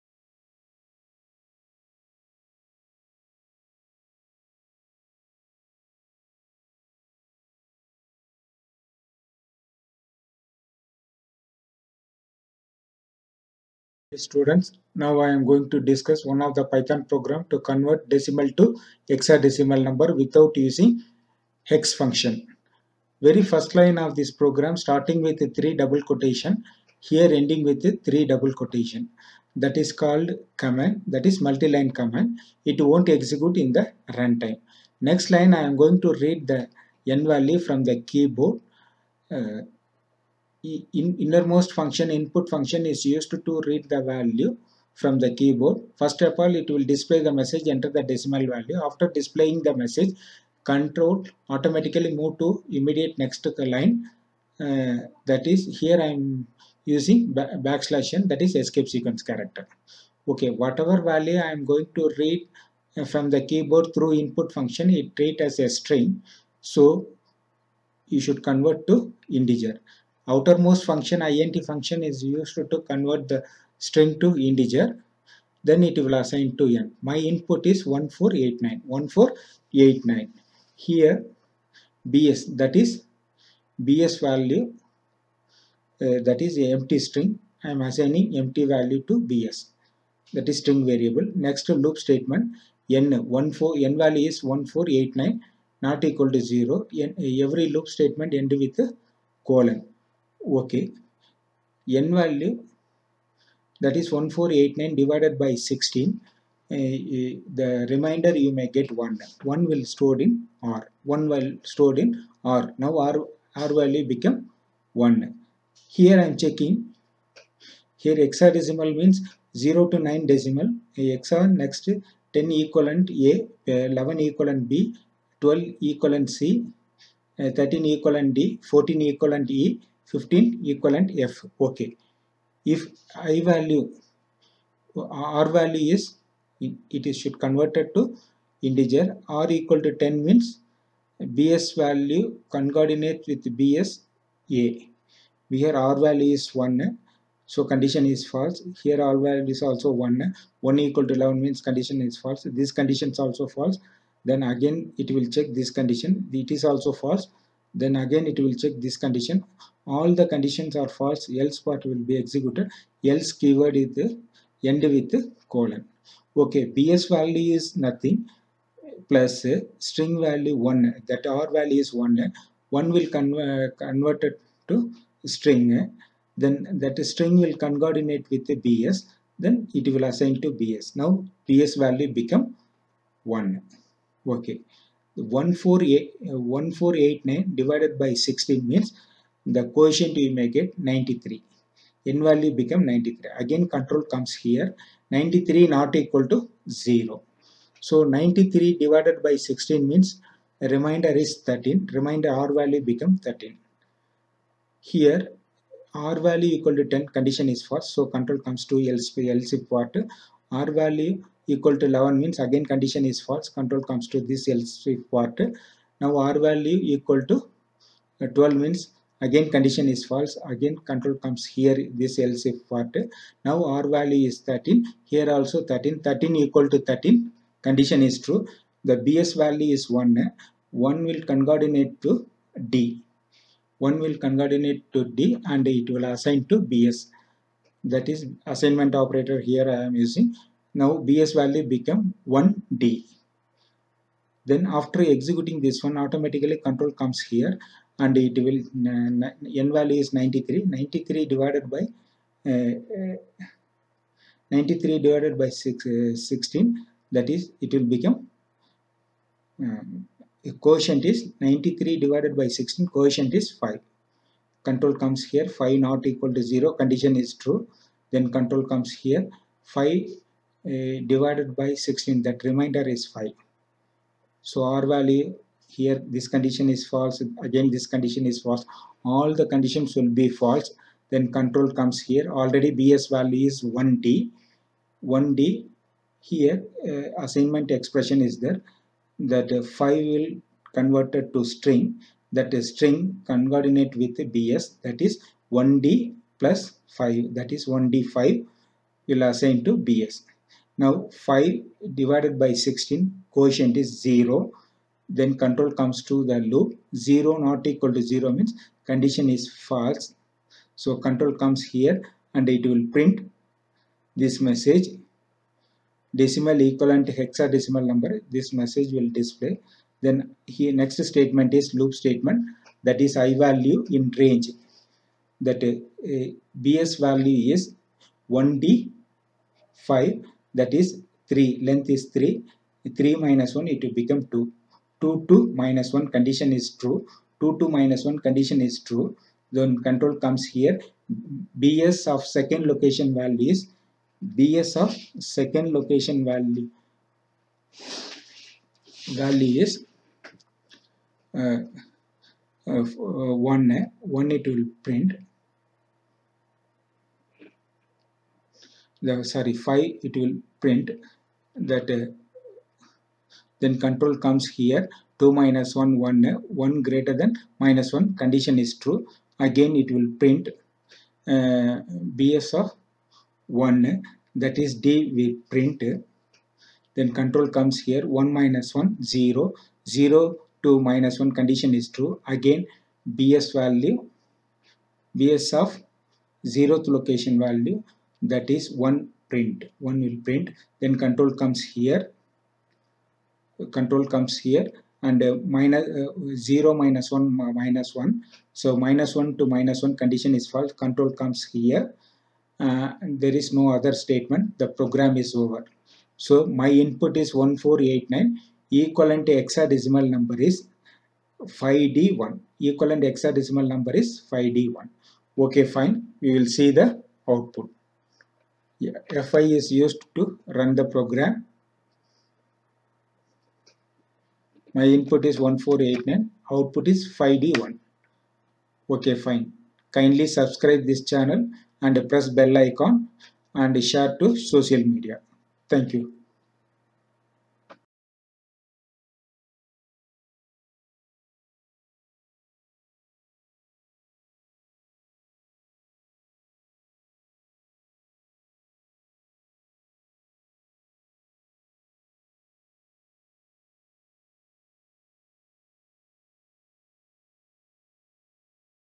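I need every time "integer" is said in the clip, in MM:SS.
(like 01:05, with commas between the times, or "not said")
01:09, 01:14, 02:18.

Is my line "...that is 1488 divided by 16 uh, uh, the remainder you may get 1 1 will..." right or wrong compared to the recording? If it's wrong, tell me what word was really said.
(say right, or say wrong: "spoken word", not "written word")
wrong: "1489", not "1488".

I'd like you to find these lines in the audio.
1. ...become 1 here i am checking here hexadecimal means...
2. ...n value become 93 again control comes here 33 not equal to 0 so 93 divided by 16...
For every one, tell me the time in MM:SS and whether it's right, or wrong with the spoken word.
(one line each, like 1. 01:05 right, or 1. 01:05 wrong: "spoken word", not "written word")
1. 01:54 right
2. 03:12 wrong: "93", not "33".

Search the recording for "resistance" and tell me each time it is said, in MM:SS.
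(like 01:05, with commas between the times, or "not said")
not said.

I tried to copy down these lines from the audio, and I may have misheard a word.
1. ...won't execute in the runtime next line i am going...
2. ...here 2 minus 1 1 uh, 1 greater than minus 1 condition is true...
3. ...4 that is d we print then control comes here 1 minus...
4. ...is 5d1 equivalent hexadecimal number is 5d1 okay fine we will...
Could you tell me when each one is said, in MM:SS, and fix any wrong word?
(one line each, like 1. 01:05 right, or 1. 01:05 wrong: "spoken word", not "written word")
1. 00:32 right
2. 06:04 right
3. 06:13 wrong: "1", not "4"
4. 06:50 right.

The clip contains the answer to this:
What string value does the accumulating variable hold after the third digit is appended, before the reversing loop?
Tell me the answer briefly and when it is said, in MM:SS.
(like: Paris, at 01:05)
1d5, at 04:57.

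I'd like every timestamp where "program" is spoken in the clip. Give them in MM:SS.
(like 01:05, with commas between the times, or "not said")
00:17, 00:24, 06:44, 07:00.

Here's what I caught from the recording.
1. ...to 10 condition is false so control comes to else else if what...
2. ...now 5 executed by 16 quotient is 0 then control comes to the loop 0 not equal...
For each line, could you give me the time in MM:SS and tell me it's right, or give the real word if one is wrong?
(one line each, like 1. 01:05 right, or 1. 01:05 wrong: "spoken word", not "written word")
1. 03:26 right
2. 05:00 wrong: "divided", not "executed".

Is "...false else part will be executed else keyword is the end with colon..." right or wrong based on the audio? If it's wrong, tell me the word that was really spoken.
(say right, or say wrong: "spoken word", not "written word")
right.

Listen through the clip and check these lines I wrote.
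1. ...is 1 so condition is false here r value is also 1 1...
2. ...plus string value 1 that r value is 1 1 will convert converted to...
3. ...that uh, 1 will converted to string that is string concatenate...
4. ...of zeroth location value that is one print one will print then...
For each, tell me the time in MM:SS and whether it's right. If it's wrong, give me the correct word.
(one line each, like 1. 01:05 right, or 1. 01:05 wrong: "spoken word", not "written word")
1. 02:26 right
2. 02:49 right
3. 04:49 wrong: "5", not "1"
4. 06:25 right.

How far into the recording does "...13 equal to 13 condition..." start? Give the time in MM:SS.
03:46.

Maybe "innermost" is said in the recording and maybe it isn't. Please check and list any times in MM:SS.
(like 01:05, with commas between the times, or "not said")
00:41.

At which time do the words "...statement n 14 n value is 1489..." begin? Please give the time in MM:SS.
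01:31.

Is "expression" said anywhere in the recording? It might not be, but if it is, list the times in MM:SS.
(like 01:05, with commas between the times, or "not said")
04:47.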